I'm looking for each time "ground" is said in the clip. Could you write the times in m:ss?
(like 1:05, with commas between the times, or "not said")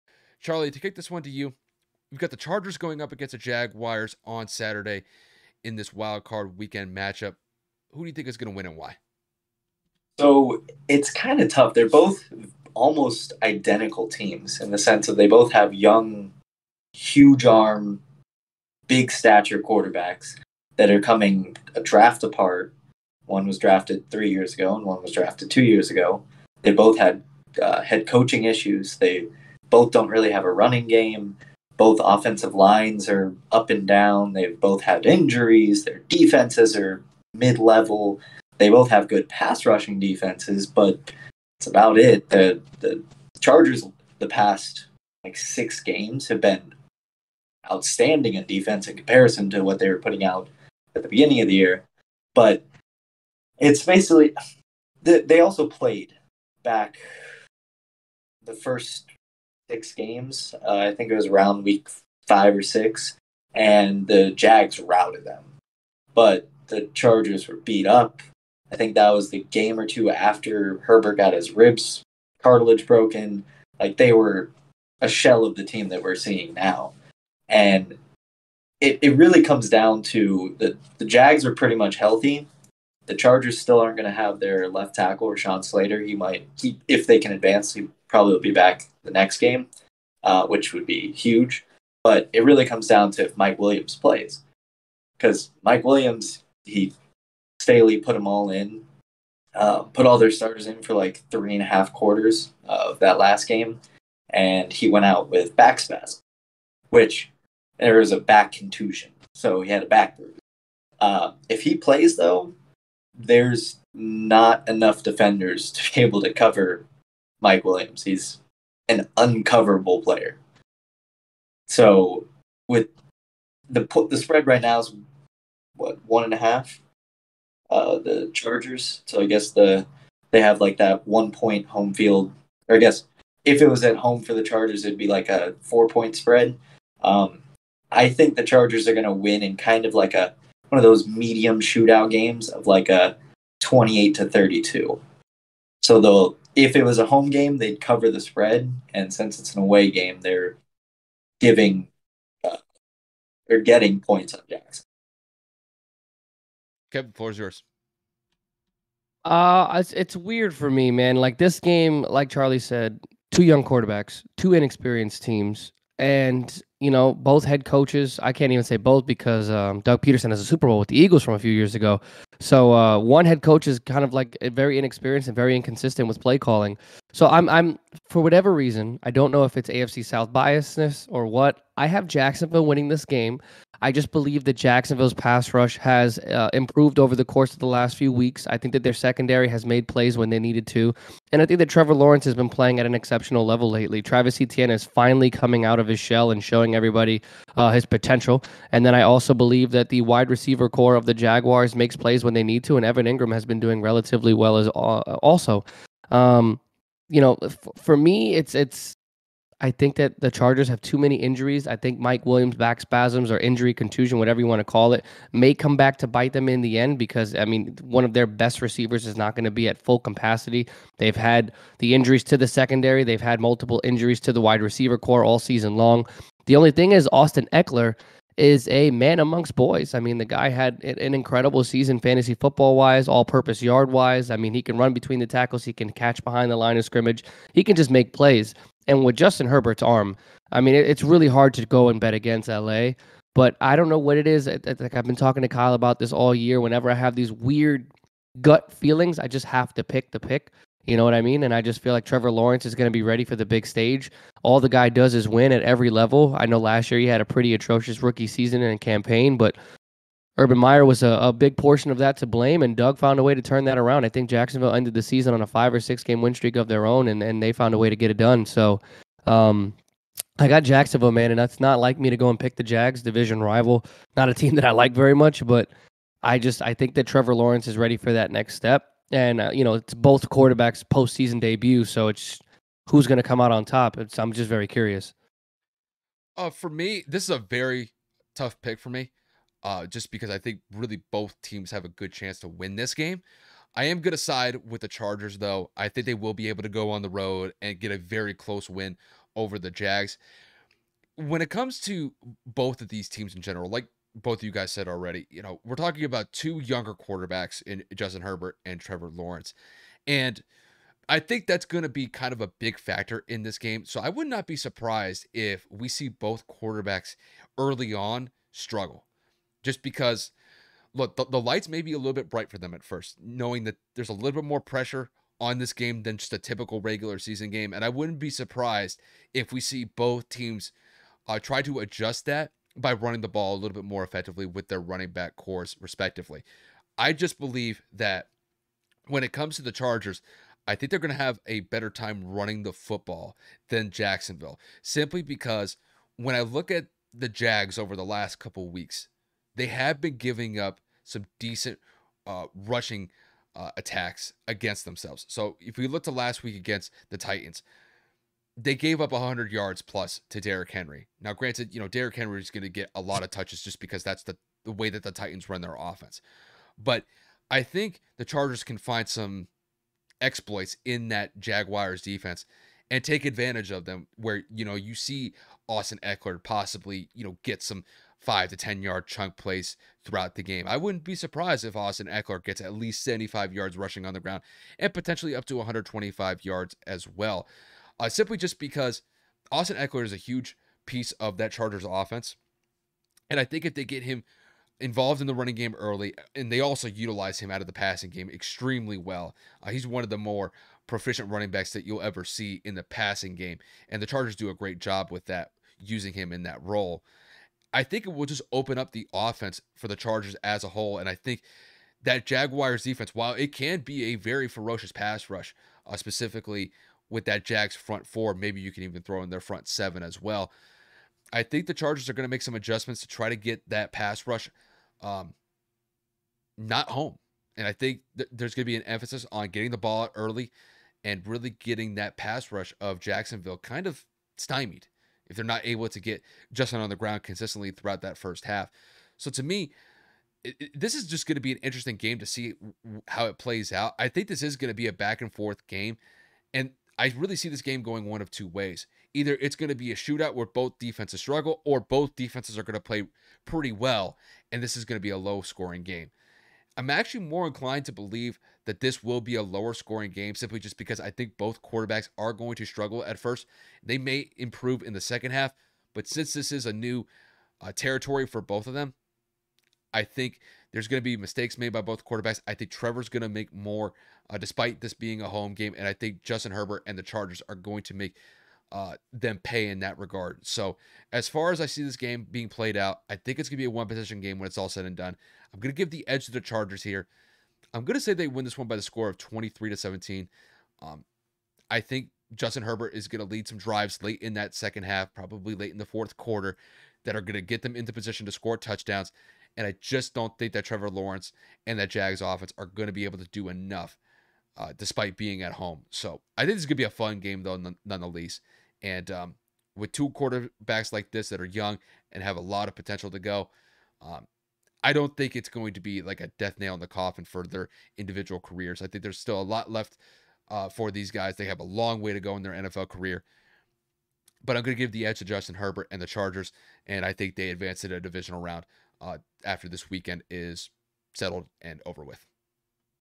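6:24, 7:16.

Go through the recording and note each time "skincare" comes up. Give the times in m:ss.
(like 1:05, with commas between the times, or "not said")
not said.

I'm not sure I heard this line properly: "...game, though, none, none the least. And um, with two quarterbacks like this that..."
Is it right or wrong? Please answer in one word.
right.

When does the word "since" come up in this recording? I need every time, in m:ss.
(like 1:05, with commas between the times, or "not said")
2:29, 7:46.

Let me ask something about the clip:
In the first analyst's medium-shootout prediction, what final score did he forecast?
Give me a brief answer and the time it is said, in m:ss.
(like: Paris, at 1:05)
28 to 32, at 2:23.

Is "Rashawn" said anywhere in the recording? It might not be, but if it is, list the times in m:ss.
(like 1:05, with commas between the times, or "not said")
1:25.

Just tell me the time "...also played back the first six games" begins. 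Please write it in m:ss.
0:55.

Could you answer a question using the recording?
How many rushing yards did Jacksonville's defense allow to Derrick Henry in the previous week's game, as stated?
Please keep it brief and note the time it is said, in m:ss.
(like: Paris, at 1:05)
100 yards plus, at 5:59.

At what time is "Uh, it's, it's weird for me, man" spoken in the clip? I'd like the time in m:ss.
2:39.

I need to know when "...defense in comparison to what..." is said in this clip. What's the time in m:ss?
0:48.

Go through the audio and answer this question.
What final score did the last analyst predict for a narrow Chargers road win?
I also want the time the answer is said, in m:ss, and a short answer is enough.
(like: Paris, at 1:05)
23 to 17, at 8:09.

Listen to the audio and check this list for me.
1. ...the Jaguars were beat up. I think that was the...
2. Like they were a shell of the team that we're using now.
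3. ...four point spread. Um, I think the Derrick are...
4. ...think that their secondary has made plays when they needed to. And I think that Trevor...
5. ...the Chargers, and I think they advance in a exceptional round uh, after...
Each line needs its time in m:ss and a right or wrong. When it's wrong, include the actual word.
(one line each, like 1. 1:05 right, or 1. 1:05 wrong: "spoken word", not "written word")
1. 1:06 wrong: "Chargers", not "Jaguars"
2. 1:13 wrong: "seeing", not "using"
3. 2:15 wrong: "Chargers", not "Derrick"
4. 3:08 right
5. 8:46 wrong: "divisional", not "exceptional".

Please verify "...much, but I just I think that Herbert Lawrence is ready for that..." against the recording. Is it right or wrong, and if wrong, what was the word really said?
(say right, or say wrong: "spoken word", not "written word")
wrong: "Trevor", not "Herbert".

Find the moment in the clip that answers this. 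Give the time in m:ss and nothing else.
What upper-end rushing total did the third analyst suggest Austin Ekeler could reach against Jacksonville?
6:25.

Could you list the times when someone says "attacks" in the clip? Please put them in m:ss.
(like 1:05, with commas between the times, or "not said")
5:53.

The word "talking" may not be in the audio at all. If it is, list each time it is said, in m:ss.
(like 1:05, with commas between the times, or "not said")
4:05, 5:05.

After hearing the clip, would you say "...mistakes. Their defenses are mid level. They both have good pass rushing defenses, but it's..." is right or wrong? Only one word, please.
wrong.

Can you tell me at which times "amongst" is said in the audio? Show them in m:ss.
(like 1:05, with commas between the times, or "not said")
3:49.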